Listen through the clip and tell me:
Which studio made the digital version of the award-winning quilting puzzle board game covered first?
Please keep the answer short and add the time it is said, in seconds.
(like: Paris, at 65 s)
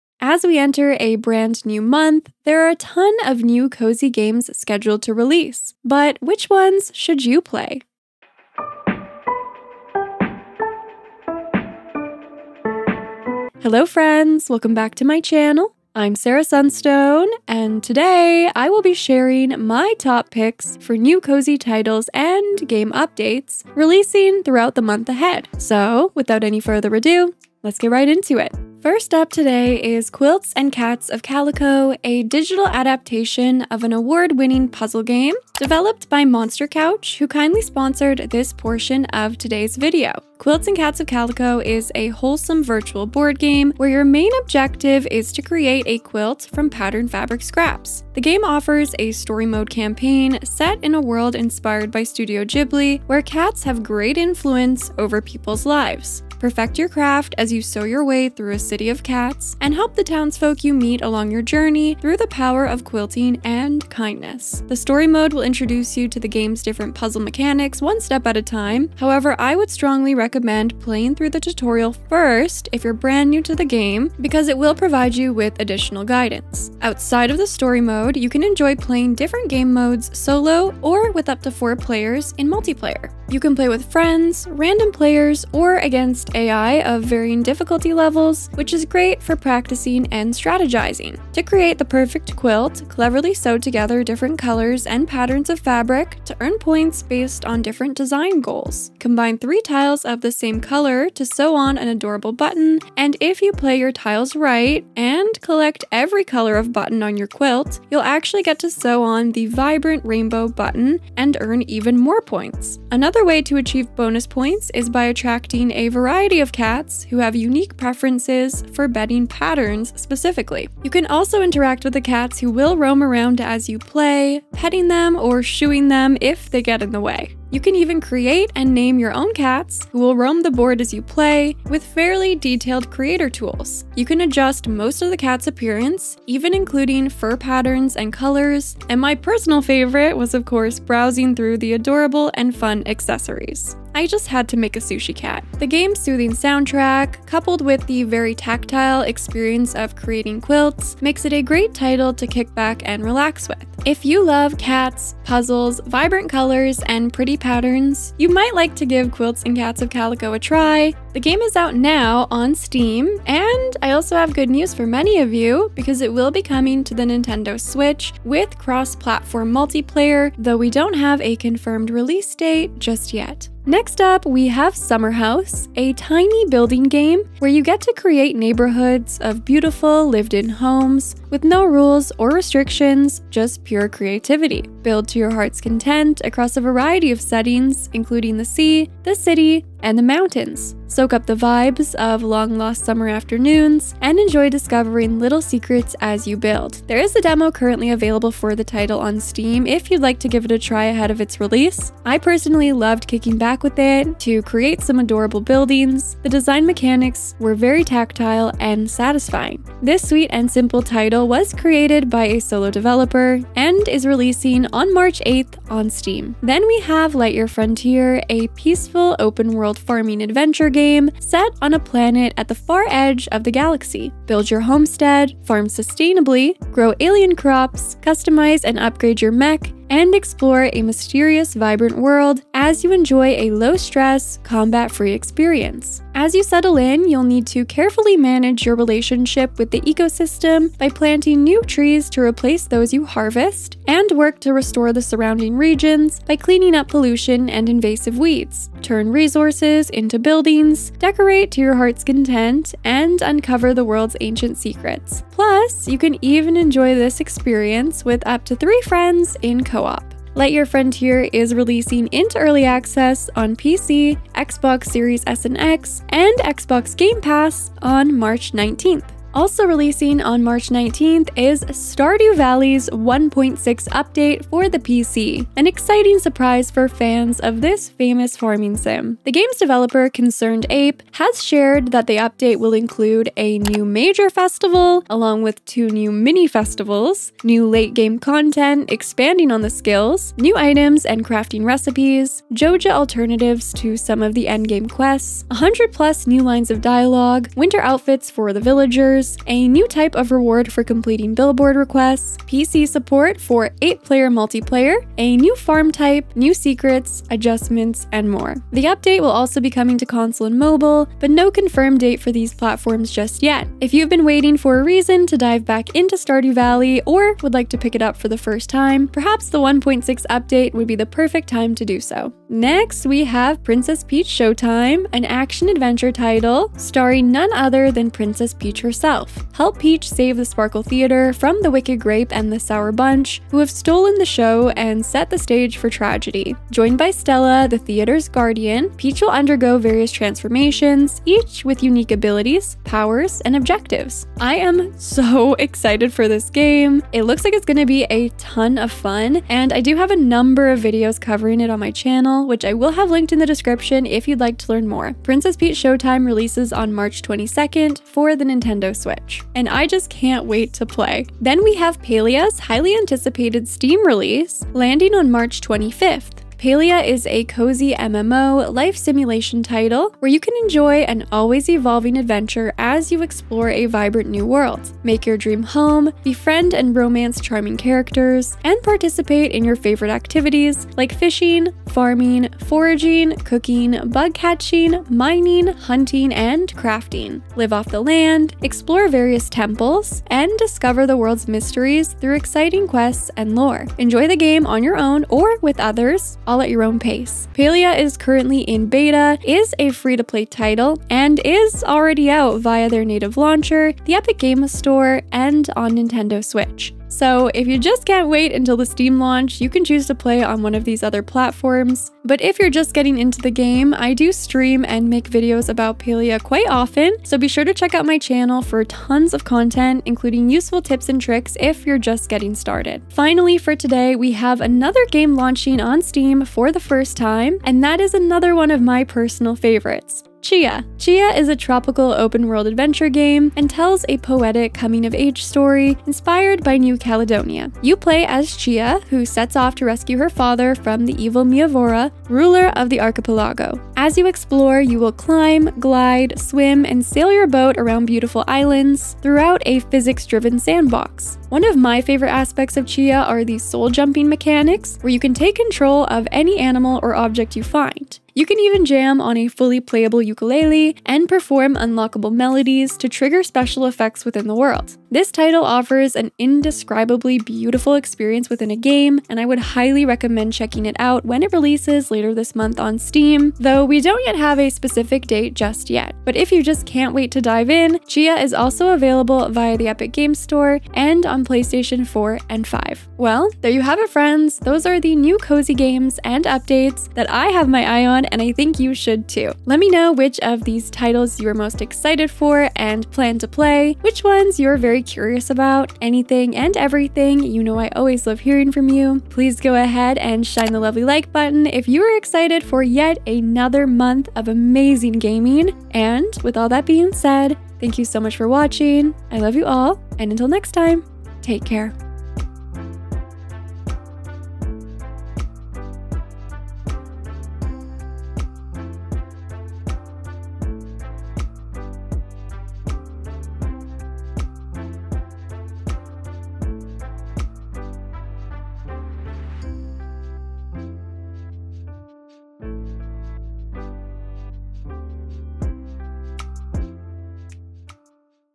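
Monster Couch, at 36 s.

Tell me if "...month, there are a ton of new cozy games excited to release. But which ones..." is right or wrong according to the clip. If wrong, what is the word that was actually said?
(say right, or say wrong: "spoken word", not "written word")
wrong: "scheduled", not "excited".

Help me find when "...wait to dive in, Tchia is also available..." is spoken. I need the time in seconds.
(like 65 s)
477 s.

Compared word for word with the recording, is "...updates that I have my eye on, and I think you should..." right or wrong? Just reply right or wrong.
right.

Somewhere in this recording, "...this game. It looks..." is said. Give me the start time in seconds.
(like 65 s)
346 s.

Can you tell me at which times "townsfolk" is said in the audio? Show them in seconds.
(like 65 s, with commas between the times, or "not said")
60 s.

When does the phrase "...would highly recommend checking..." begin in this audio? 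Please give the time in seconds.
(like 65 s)
469 s.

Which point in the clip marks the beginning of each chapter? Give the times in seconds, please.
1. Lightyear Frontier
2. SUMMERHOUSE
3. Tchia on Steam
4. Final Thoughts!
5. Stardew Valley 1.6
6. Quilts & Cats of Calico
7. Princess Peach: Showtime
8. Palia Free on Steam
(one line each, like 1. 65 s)
1. 216 s
2. 173 s
3. 423 s
4. 483 s
5. 269 s
6. 28 s
7. 322 s
8. 361 s.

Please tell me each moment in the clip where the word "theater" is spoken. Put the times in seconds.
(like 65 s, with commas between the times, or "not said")
330 s, 337 s.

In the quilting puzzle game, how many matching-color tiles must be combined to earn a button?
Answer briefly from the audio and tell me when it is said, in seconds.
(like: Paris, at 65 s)
3, at 99 s.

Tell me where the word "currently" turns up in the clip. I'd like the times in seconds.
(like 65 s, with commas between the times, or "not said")
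197 s, 398 s.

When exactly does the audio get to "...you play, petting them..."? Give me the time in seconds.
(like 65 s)
123 s.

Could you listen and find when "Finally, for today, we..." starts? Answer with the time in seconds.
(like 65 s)
423 s.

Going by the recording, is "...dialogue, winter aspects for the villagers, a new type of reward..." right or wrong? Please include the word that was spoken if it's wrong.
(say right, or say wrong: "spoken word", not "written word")
wrong: "outfits", not "aspects".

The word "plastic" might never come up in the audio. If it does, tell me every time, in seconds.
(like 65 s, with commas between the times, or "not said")
not said.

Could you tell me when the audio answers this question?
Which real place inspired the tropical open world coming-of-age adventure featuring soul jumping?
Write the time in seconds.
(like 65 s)
436 s.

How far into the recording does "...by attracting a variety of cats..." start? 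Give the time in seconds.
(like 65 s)
114 s.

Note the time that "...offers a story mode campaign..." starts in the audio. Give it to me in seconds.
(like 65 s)
48 s.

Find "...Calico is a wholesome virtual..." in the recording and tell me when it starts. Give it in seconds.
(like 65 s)
41 s.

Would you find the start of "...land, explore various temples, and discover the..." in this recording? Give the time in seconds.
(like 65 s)
388 s.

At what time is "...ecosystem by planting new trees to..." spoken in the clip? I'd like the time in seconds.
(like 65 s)
239 s.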